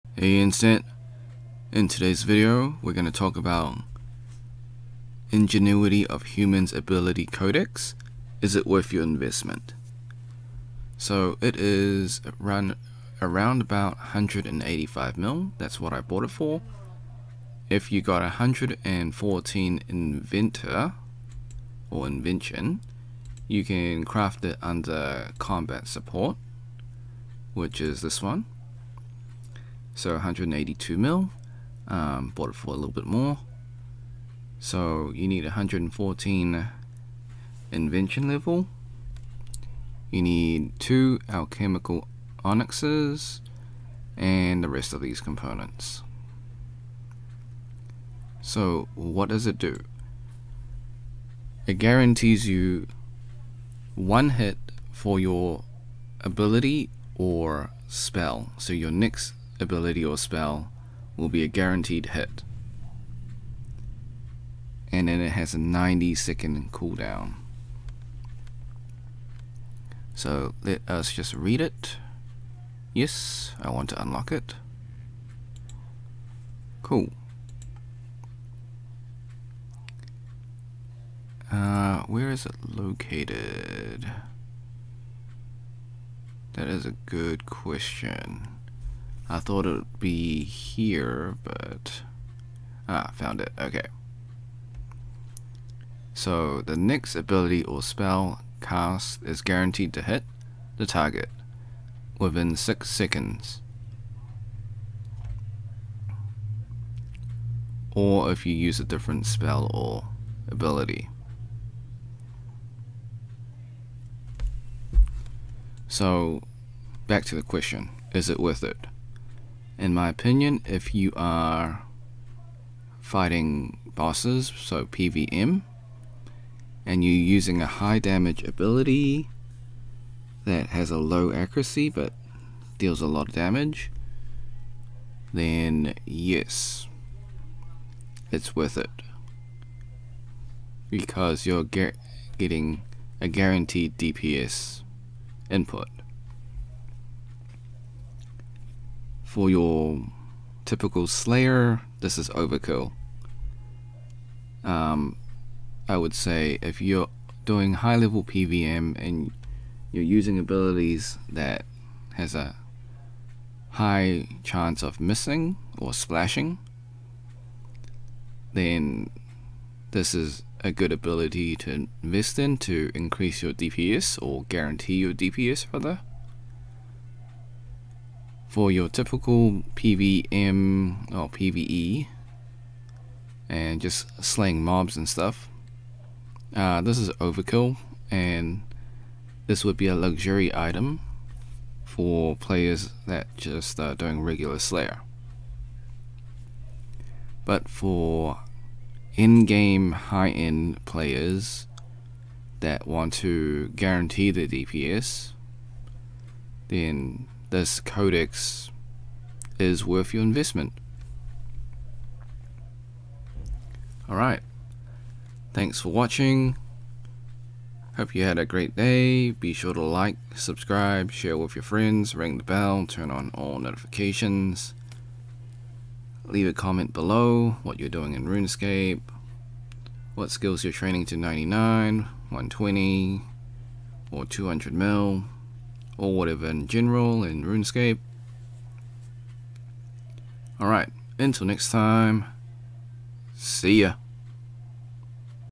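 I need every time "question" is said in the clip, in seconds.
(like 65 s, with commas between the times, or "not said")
87 s, 117 s.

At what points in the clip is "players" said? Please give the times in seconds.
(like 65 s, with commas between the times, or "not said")
192 s, 200 s.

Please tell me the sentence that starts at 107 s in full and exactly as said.
Or if you use a different spell or ability.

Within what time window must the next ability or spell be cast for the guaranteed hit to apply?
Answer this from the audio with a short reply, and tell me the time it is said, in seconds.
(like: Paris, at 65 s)
6 seconds, at 102 s.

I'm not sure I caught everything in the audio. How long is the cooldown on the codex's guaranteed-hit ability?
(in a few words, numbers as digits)
90 seconds.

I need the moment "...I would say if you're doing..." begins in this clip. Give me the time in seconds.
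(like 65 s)
155 s.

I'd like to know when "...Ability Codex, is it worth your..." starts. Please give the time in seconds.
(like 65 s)
6 s.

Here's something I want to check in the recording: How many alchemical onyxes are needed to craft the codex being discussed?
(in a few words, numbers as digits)
2.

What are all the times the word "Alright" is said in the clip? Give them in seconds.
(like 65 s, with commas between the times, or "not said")
214 s, 240 s.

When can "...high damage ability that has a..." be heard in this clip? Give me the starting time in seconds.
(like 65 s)
127 s.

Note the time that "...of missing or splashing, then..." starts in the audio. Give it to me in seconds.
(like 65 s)
164 s.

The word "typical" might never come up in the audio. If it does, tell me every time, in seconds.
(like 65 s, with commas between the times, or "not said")
150 s, 178 s.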